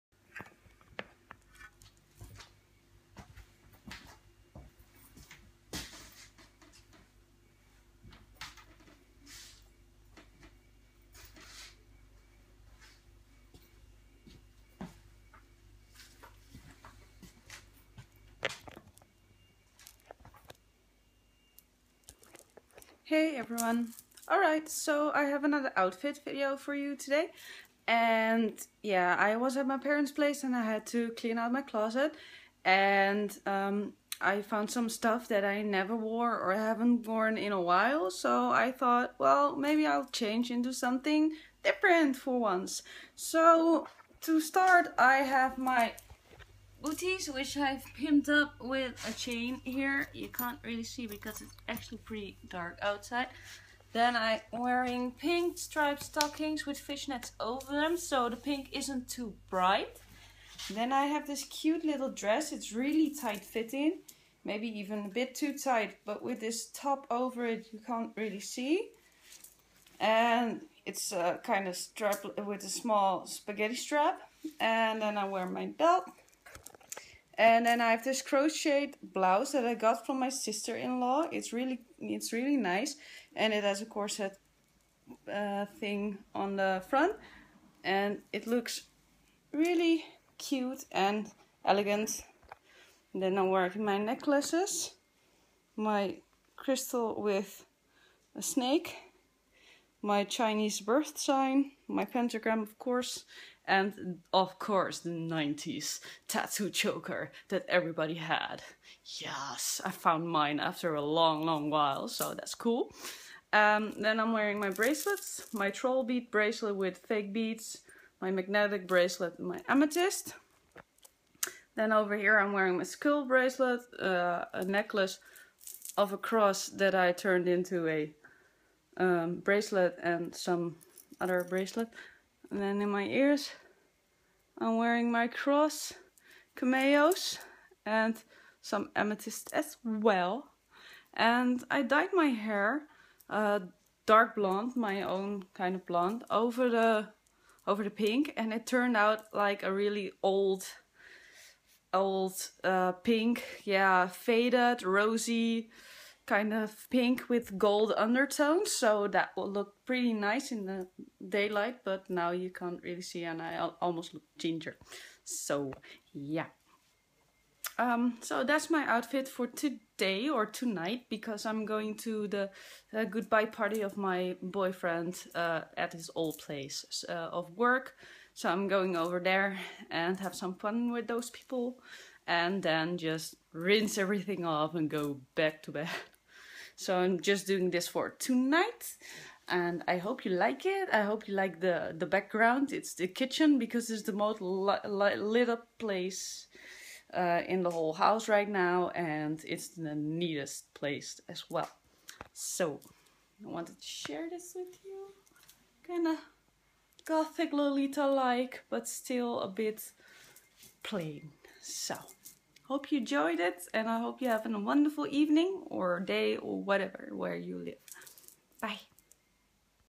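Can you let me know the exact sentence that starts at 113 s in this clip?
Um, then I'm wearing my bracelets, my troll bead bracelet with fake beads, my magnetic bracelet, my amethyst.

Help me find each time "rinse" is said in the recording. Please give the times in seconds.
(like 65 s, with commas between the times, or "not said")
183 s.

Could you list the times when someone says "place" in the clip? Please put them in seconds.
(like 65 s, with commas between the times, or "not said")
30 s, 176 s, 195 s, 200 s.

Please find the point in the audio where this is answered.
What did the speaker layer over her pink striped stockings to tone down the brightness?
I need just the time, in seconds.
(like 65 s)
56 s.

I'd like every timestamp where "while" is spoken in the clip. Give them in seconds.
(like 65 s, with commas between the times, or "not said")
37 s, 111 s.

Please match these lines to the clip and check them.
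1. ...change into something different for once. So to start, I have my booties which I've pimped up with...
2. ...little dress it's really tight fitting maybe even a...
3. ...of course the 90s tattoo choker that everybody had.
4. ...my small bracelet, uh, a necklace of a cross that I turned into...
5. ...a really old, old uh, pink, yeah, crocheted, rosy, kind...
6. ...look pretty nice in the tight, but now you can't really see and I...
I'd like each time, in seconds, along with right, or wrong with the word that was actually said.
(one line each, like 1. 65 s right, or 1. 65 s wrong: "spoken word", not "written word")
1. 40 s right
2. 61 s right
3. 104 s right
4. 122 s wrong: "skull", not "small"
5. 149 s wrong: "faded", not "crocheted"
6. 159 s wrong: "daylight", not "tight".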